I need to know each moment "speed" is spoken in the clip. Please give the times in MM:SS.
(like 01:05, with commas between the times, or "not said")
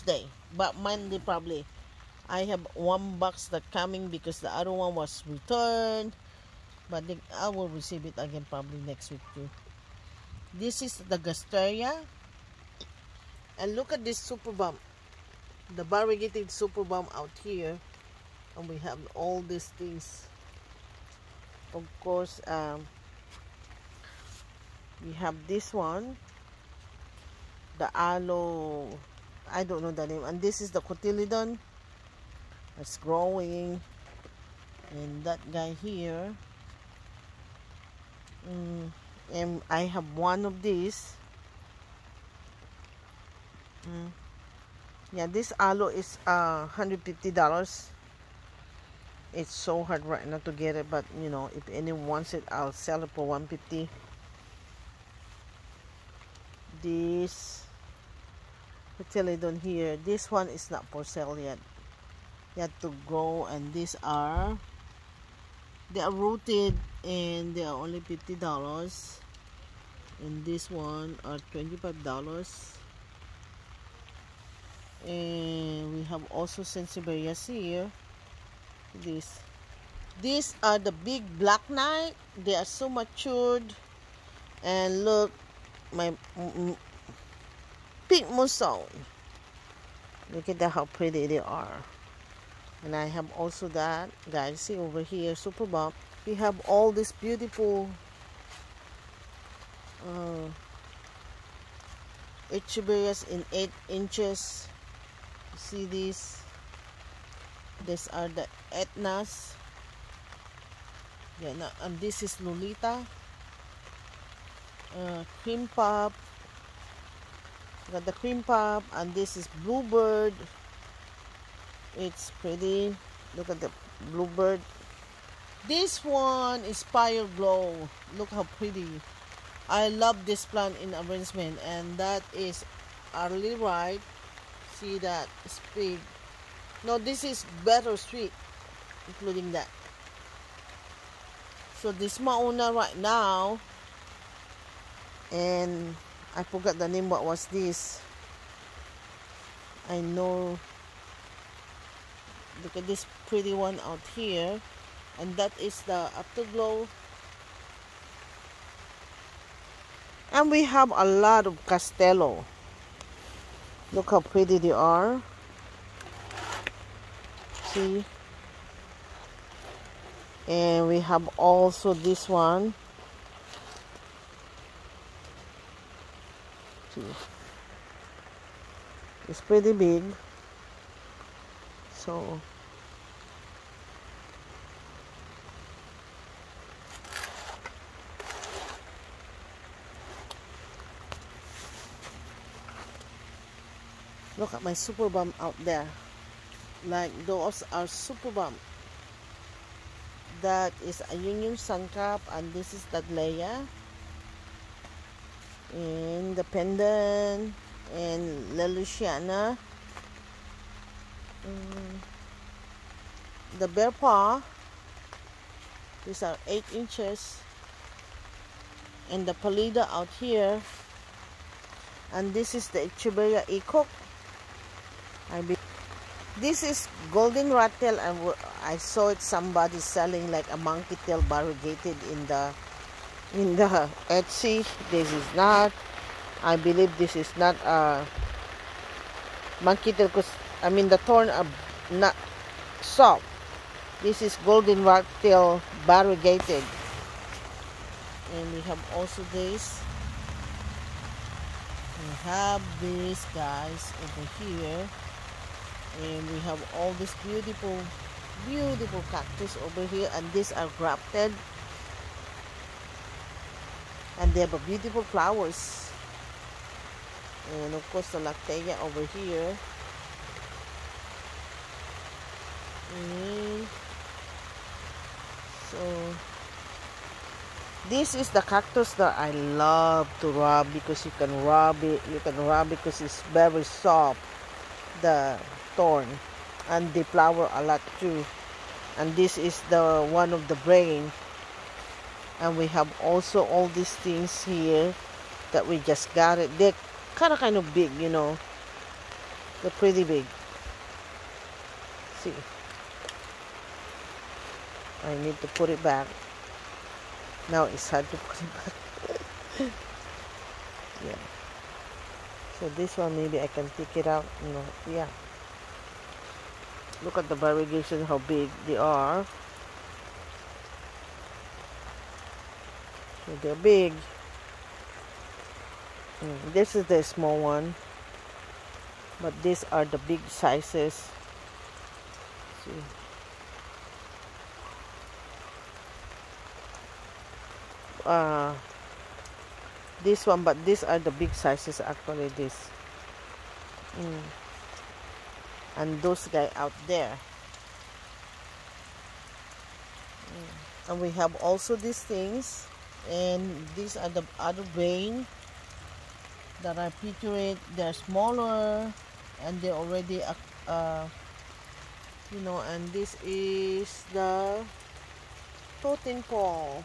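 02:15.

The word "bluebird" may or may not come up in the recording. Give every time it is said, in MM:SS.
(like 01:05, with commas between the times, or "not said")
01:59, 02:04.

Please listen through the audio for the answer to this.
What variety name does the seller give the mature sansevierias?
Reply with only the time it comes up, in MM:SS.
01:21.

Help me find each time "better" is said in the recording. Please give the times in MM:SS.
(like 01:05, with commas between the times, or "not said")
02:17.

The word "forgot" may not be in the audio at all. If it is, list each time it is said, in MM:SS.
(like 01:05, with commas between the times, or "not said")
02:26.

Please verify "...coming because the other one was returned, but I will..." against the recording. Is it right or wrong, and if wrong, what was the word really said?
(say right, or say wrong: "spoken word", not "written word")
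right.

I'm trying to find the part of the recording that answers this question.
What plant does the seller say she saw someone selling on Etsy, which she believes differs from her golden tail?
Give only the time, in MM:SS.
03:50.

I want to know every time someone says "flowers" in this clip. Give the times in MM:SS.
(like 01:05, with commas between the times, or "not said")
04:25, 04:47.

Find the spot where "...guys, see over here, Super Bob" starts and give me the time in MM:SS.
01:34.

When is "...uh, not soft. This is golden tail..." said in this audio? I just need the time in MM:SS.
04:01.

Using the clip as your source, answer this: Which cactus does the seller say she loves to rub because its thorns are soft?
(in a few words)
lactea.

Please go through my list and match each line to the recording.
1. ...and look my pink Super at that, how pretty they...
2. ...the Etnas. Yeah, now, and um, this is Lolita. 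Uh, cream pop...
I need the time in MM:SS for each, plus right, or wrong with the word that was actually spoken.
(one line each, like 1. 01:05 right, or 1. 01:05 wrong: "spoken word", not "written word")
1. 01:24 wrong: "Look", not "Super"
2. 01:48 right.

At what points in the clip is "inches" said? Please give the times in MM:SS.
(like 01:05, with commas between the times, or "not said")
01:43, 03:36.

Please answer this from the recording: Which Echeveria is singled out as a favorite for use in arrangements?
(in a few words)
Fire Glow.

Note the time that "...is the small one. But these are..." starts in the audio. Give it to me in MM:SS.
05:26.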